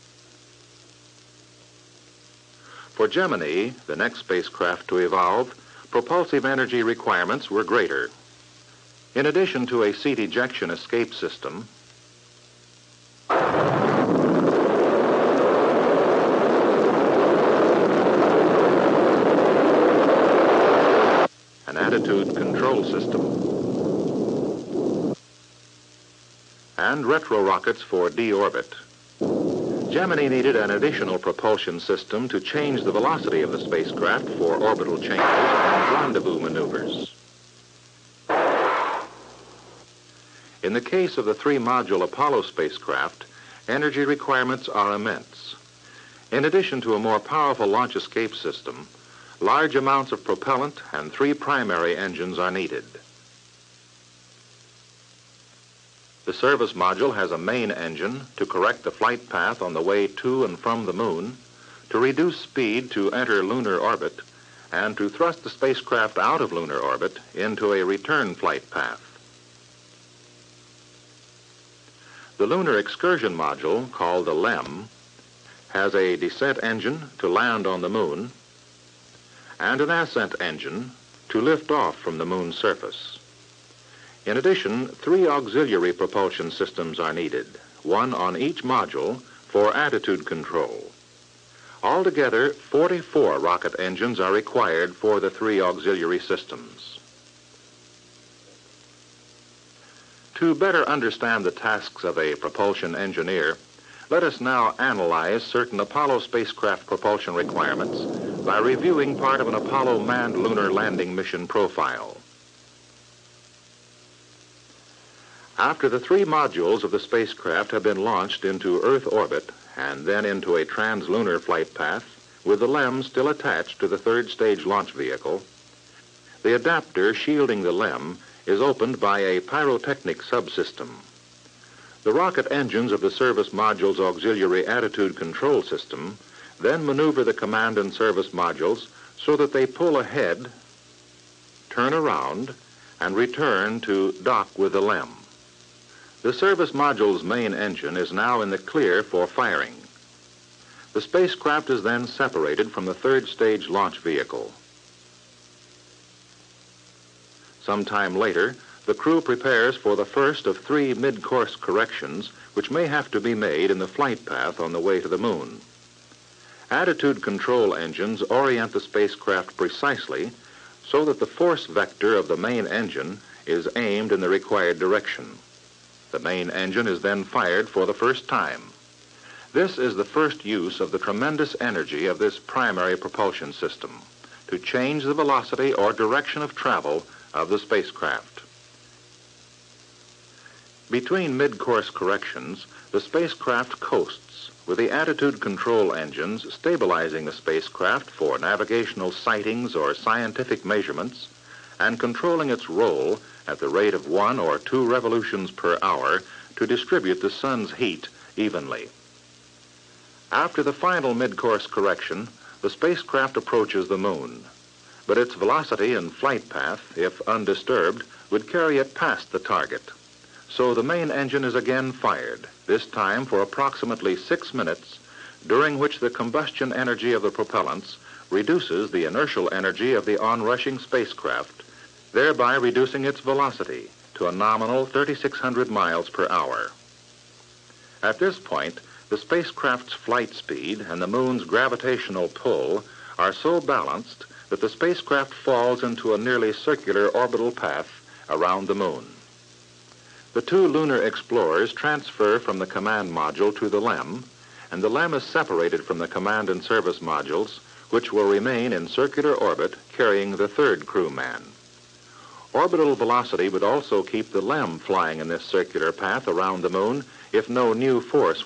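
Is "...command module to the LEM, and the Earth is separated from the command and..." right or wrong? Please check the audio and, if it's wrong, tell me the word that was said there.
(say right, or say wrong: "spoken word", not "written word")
wrong: "LEM", not "Earth".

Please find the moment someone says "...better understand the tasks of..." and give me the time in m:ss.
1:40.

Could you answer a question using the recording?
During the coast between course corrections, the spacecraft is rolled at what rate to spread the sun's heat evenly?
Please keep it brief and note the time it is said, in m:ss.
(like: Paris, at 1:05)
1 or 2 revolutions per hour, at 3:24.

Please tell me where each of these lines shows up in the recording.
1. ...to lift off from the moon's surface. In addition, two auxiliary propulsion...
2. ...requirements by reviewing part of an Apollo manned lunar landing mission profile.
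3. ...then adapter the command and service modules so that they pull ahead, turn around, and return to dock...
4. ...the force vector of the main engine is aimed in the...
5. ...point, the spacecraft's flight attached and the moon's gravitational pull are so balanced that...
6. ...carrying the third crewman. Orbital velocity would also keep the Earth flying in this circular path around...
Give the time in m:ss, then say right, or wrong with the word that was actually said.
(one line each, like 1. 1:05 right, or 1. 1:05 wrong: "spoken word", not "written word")
1. 1:21 wrong: "three", not "two"
2. 1:47 right
3. 2:16 wrong: "maneuver", not "adapter"
4. 2:51 right
5. 3:58 wrong: "speed", not "attached"
6. 4:19 wrong: "LEM", not "Earth".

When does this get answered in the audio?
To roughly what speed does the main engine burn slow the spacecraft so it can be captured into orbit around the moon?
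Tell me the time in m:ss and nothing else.
3:54.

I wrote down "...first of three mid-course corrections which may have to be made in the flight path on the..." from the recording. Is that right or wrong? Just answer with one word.
right.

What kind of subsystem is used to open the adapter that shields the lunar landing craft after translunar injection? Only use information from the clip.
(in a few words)
pyrotechnic subsystem.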